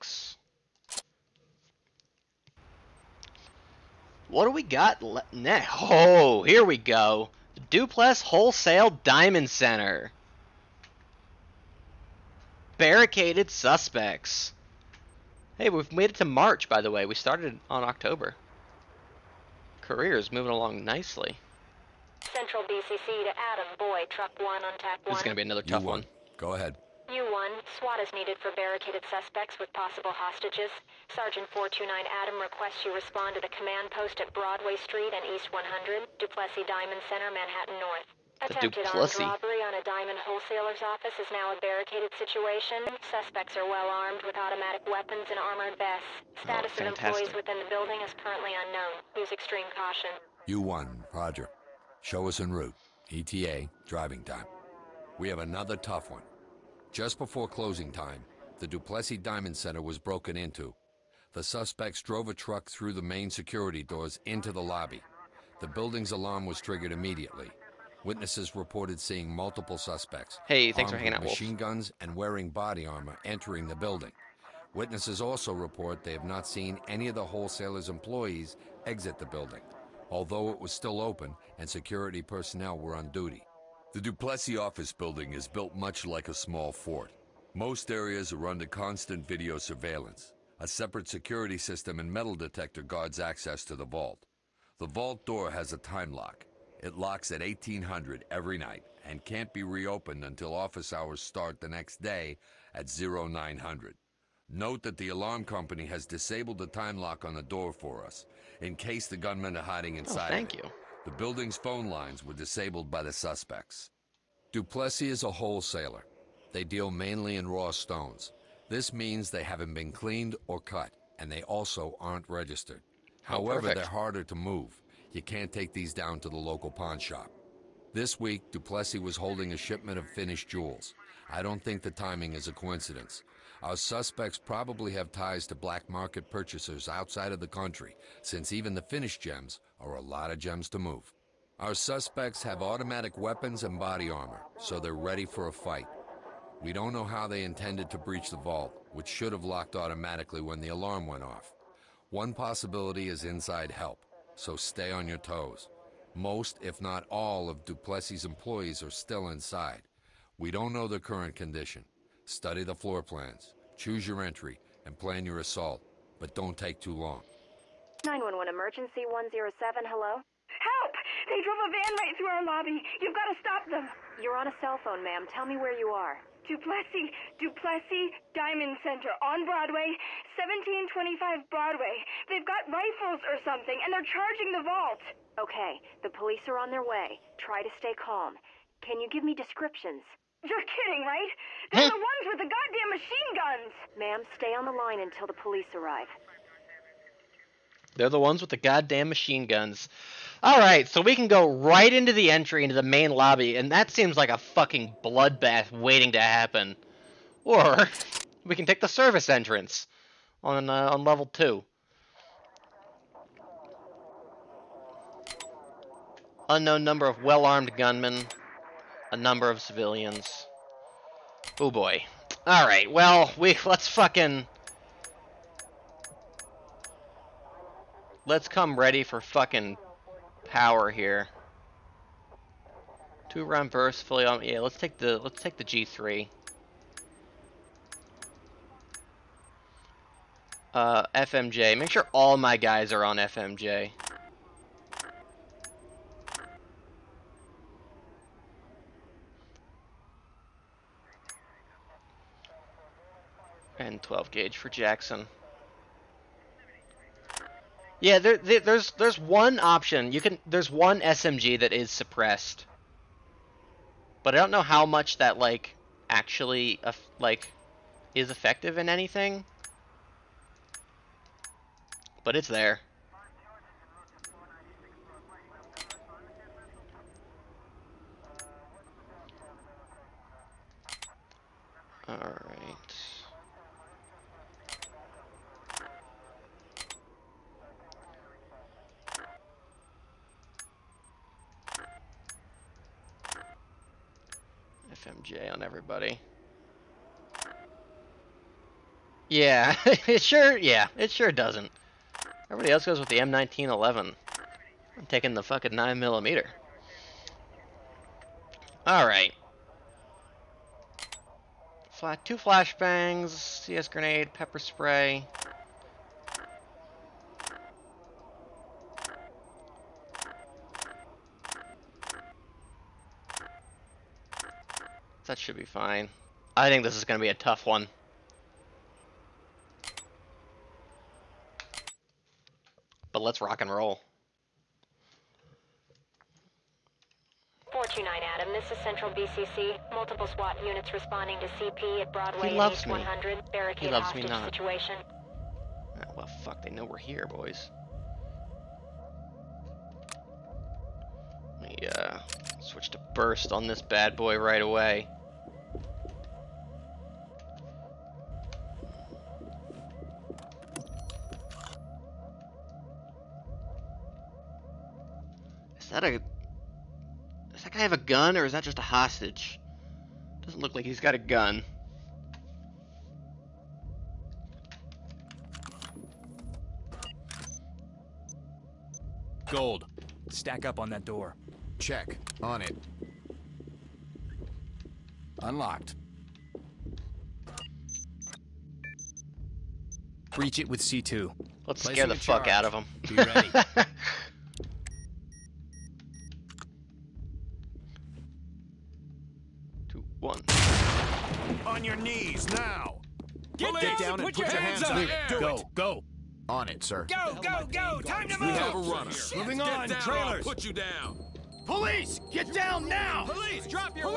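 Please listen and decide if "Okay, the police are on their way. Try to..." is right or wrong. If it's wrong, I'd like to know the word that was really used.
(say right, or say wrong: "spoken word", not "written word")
right.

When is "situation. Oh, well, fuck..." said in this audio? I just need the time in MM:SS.
05:44.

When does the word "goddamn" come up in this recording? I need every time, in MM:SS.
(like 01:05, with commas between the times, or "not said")
03:12, 03:18.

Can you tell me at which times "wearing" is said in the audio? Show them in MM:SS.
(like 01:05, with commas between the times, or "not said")
01:12.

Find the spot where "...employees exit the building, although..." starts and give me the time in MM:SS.
01:17.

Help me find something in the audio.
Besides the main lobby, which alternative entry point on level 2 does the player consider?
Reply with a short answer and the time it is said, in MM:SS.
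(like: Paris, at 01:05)
Service entrance, at 03:28.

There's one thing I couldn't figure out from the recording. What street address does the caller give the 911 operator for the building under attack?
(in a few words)
1725 Broadway.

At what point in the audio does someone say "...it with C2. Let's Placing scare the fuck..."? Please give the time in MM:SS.
06:30.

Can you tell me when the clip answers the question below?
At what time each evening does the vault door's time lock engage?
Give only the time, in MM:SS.
01:37.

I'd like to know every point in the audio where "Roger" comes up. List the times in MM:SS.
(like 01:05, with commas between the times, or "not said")
00:51.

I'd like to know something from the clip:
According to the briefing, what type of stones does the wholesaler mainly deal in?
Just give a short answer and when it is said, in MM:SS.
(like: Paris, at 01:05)
Raw stones, at 01:57.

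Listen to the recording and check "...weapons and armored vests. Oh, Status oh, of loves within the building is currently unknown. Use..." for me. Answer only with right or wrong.
wrong.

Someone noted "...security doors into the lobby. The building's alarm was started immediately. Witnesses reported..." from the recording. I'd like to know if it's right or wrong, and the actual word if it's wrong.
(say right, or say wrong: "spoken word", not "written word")
wrong: "triggered", not "started".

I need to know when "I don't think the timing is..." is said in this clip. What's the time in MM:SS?
02:11.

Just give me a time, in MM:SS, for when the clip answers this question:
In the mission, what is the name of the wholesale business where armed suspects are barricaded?
00:07.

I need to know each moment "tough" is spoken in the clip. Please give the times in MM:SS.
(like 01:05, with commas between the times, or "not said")
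00:25, 00:55, 05:27.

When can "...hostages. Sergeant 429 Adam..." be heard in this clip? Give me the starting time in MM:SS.
00:30.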